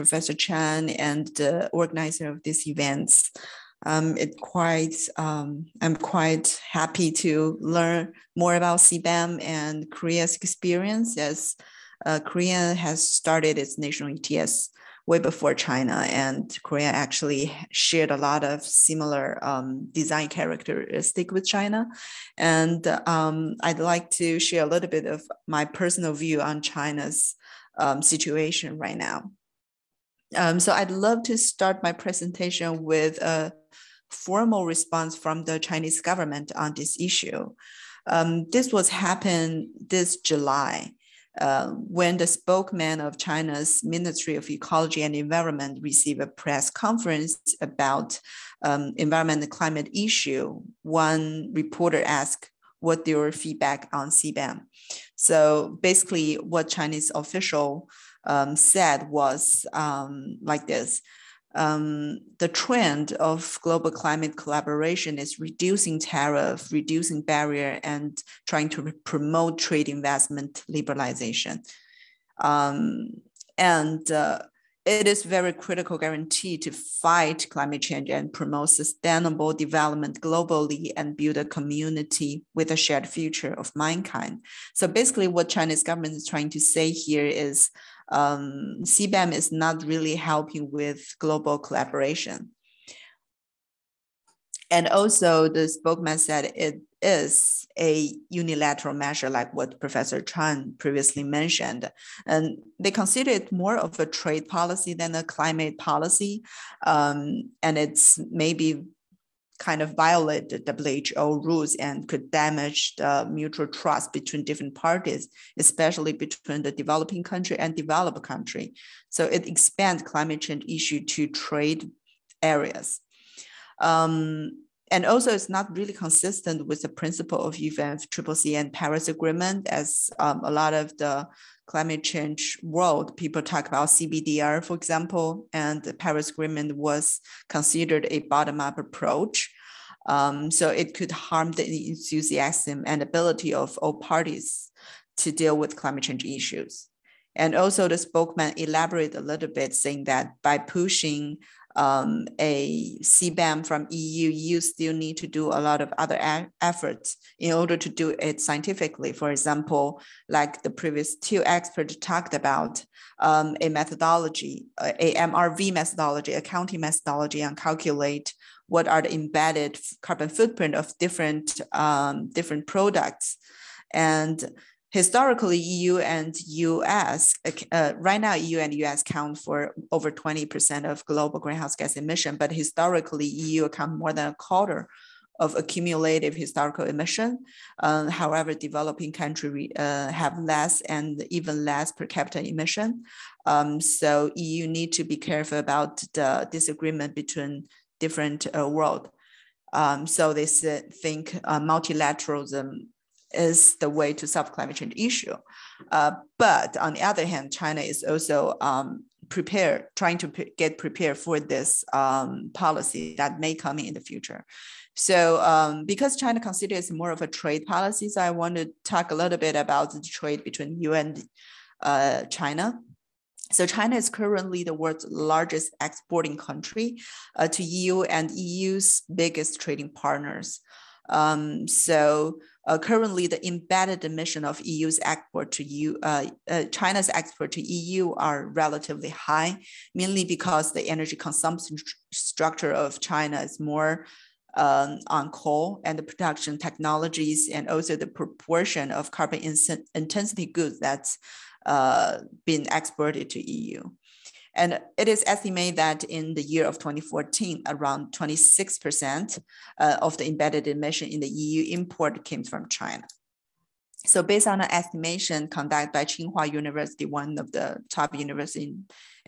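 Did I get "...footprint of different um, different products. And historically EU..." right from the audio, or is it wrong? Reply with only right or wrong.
right.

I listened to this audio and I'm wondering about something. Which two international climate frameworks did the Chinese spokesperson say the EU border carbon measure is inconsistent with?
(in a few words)
UNFCCC and Paris Agreement.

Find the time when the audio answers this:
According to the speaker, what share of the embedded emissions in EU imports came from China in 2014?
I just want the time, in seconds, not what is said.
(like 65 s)
258 s.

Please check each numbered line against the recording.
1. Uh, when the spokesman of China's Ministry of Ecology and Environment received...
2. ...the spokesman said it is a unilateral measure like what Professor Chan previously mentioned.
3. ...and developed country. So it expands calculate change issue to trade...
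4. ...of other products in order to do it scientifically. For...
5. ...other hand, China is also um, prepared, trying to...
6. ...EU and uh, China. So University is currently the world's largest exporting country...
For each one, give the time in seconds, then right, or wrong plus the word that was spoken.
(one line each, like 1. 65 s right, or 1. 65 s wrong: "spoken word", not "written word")
1. 41 s right
2. 95 s right
3. 117 s wrong: "climate", not "calculate"
4. 155 s wrong: "efforts", not "products"
5. 207 s right
6. 220 s wrong: "China", not "University".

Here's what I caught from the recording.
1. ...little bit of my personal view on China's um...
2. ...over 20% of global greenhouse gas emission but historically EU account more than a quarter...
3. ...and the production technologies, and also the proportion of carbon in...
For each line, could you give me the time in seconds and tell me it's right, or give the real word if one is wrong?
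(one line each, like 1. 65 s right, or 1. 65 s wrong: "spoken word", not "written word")
1. 24 s right
2. 179 s right
3. 245 s right.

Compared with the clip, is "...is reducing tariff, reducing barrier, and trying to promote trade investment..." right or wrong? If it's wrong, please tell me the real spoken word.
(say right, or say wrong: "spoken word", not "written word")
right.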